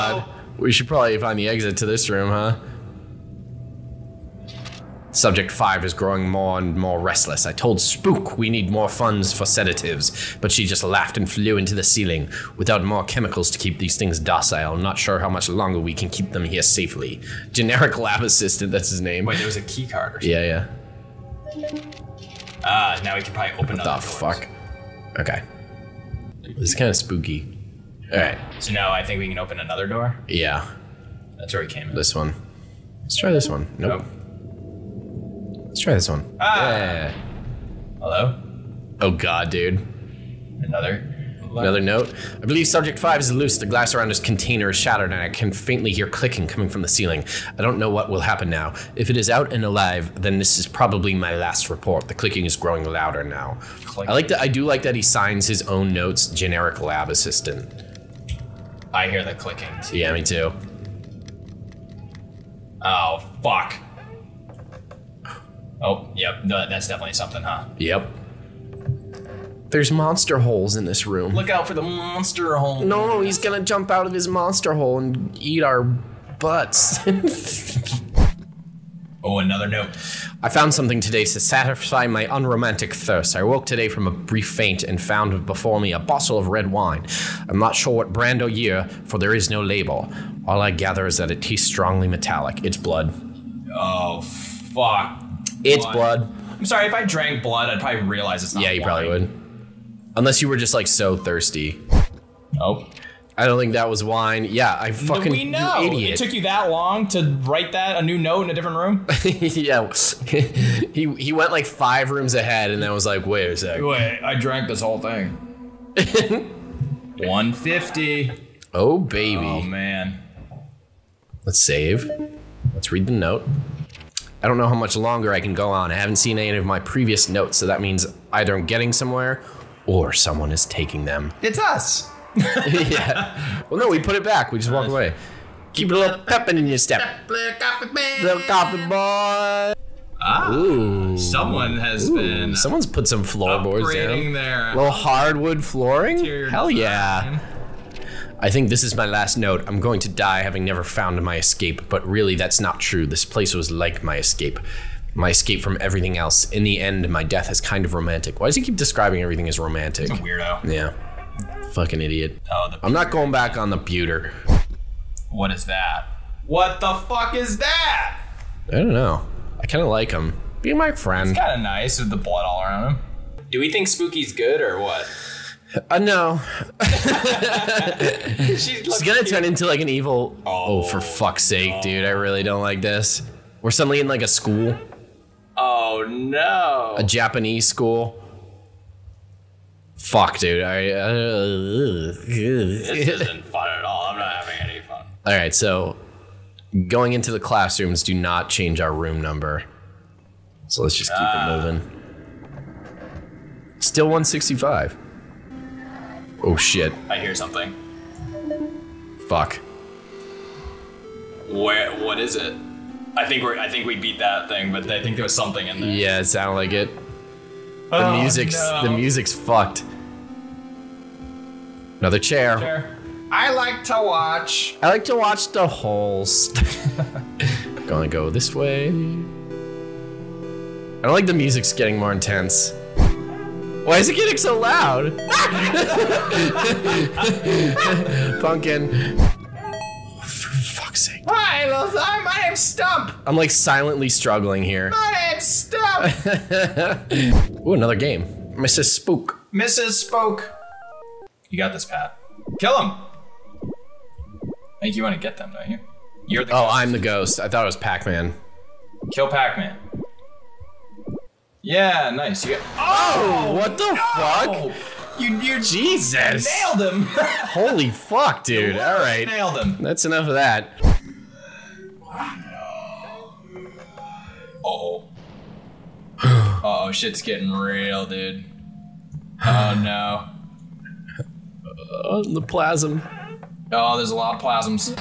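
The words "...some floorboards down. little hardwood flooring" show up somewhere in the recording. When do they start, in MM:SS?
02:23.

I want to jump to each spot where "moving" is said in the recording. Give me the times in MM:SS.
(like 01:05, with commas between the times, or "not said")
03:21.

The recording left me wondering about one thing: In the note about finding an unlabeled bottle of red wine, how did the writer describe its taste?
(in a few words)
Strongly metallic.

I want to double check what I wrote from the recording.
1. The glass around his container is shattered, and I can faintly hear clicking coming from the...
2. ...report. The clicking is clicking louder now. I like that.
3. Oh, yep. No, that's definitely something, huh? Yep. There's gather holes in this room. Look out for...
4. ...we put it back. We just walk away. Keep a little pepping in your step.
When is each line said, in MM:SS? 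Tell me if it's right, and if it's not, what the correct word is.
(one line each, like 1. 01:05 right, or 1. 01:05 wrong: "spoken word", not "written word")
1. 00:43 right
2. 00:51 wrong: "growing", not "clicking"
3. 01:05 wrong: "monster", not "gather"
4. 02:13 right.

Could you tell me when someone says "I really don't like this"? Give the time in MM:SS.
03:02.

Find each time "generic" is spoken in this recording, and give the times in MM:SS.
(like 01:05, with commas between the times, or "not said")
00:17, 00:56.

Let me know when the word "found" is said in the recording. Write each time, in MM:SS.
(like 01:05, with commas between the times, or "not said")
01:20, 01:24, 02:30.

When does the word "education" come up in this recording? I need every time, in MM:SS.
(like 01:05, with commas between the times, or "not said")
not said.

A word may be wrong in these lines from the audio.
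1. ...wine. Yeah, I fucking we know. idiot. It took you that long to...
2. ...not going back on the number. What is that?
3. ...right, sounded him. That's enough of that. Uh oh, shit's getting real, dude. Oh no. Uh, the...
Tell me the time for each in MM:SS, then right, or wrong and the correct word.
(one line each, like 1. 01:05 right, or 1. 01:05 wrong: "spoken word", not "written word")
1. 01:44 right
2. 02:42 wrong: "pewter", not "number"
3. 04:28 wrong: "nailed", not "sounded".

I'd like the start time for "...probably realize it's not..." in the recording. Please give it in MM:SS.
01:37.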